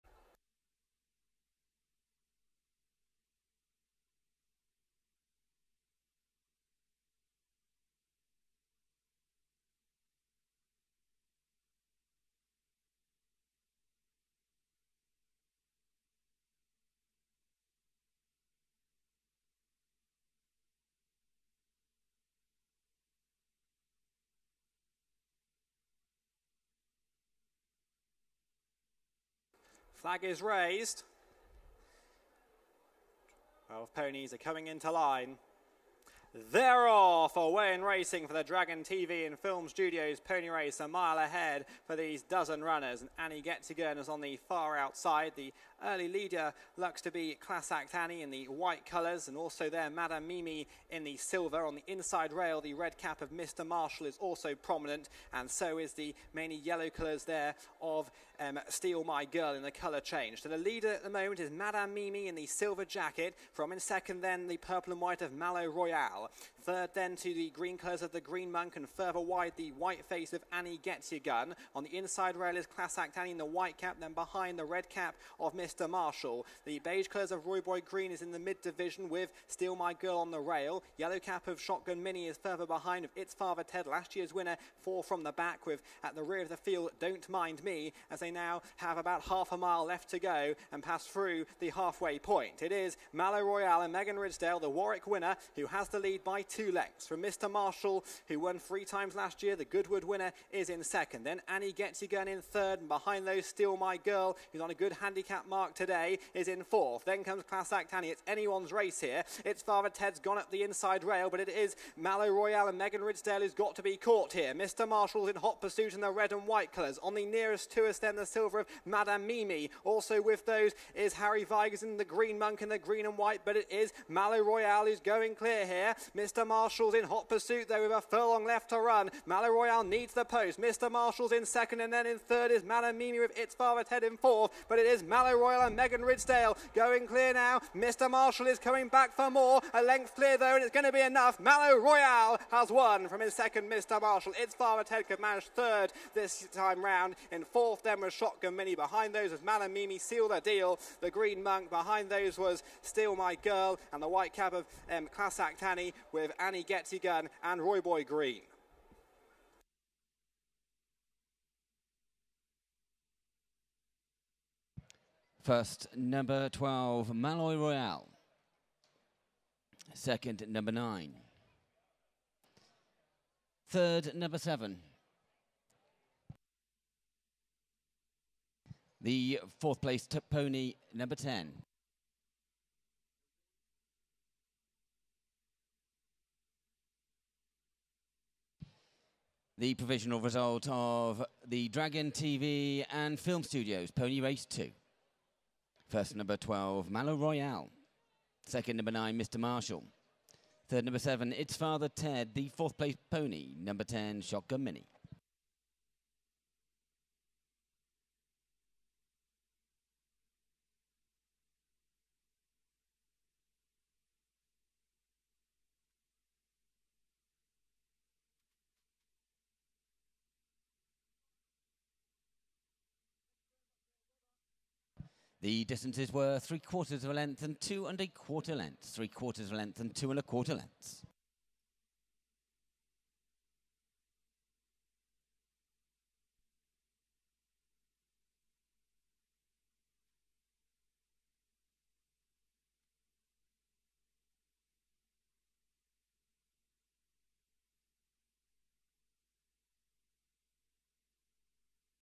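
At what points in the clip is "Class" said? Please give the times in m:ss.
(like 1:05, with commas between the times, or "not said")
0:47, 1:12, 1:47, 2:35.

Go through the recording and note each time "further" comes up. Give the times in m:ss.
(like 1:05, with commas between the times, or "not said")
1:08, 1:22.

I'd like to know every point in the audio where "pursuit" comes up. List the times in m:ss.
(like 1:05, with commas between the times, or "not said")
1:55, 2:07.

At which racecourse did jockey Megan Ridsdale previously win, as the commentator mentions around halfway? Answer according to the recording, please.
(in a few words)
Warwick.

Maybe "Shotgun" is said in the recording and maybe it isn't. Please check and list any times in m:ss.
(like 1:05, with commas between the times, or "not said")
1:21, 2:28, 3:24.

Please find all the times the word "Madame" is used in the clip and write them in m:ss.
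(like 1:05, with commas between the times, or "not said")
0:49, 1:01, 1:58, 2:12.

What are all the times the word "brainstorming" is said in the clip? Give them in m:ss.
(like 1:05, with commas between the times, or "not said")
not said.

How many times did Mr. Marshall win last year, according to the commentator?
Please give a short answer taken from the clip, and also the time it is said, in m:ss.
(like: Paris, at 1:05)
3, at 1:38.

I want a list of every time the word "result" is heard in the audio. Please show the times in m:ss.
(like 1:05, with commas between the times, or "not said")
3:10.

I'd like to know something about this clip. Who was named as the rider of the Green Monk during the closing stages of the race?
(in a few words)
Harry Vigers.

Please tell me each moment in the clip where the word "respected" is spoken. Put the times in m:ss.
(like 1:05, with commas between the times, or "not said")
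not said.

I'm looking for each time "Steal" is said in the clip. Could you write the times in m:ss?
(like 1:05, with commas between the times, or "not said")
0:58, 1:19, 1:43, 2:32.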